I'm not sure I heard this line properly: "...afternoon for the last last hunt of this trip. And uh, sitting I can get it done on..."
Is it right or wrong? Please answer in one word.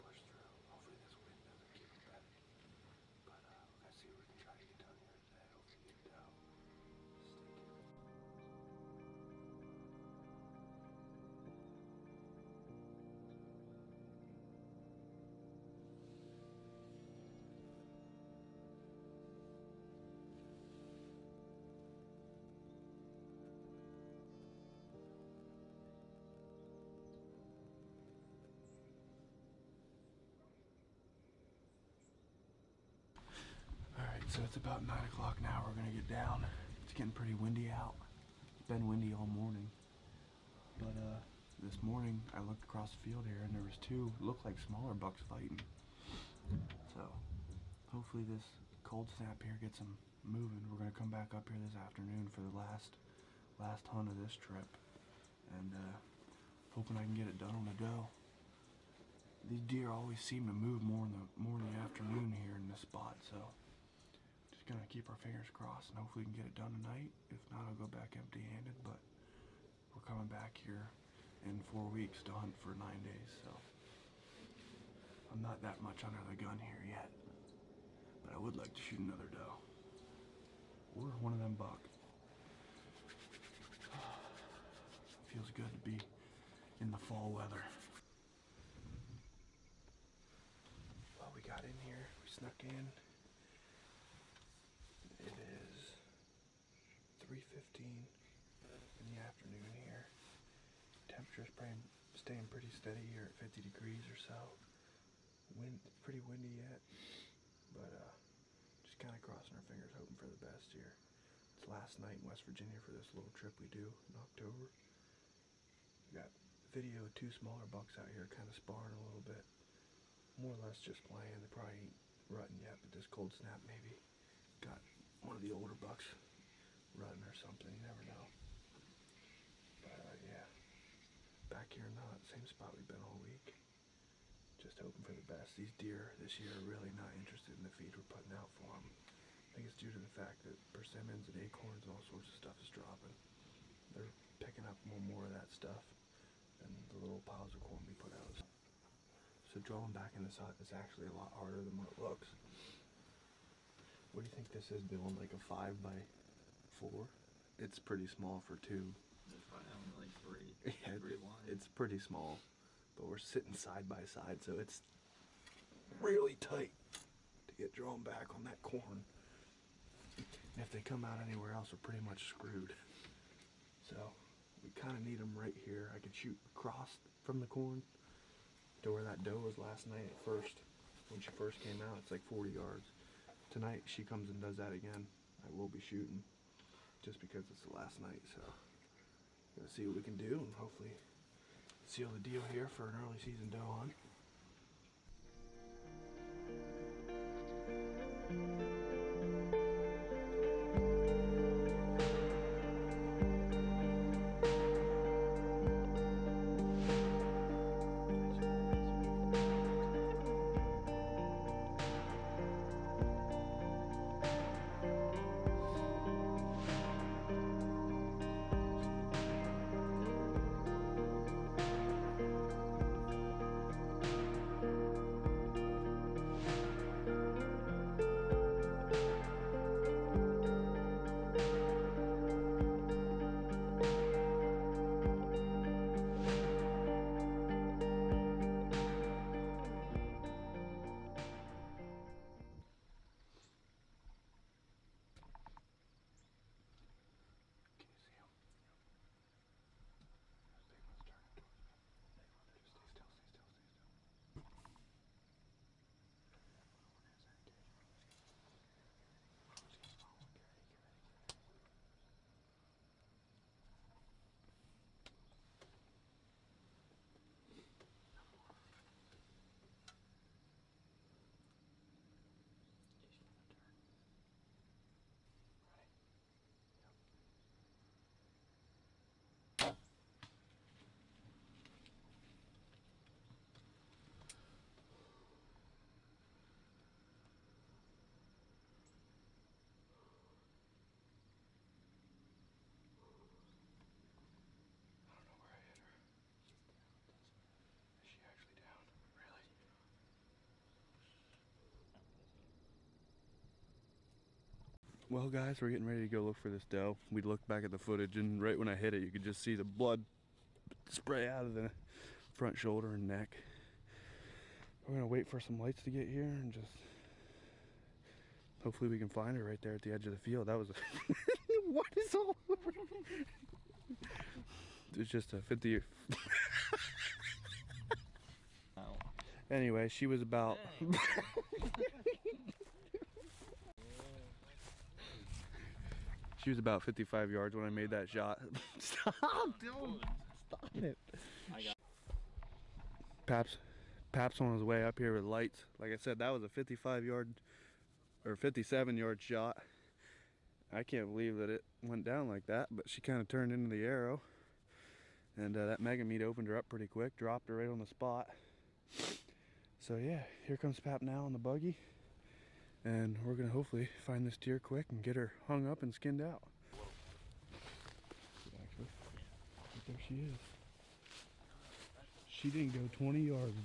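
wrong.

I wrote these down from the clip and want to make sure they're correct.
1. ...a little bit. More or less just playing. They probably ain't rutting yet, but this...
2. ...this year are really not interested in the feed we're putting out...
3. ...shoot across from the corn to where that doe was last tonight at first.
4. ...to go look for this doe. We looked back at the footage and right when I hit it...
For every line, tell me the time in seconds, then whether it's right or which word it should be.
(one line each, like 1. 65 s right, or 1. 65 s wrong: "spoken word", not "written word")
1. 118 s right
2. 136 s right
3. 176 s wrong: "night", not "tonight"
4. 306 s right.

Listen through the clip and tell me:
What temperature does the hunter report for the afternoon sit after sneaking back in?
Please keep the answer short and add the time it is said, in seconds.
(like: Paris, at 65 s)
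50 degrees, at 103 s.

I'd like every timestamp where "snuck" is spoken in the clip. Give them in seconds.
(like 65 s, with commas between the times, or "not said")
92 s.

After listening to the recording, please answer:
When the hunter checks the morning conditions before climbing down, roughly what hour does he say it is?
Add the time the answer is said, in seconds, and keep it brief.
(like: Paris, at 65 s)
9 o'clock, at 34 s.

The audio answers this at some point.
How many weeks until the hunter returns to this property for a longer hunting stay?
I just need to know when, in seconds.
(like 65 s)
71 s.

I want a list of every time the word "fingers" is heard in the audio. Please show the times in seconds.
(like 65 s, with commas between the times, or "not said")
65 s, 109 s.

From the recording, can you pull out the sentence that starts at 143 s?
They're picking up more and more of that stuff than the little piles of corn we put out.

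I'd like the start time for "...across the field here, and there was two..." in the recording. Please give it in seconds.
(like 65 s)
42 s.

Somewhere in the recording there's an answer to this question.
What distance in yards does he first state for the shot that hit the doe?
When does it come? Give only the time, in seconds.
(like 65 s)
336 s.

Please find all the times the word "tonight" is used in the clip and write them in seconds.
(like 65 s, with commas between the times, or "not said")
66 s, 183 s.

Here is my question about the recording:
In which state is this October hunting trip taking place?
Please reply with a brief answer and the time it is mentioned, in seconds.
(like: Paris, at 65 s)
West Virginia, at 112 s.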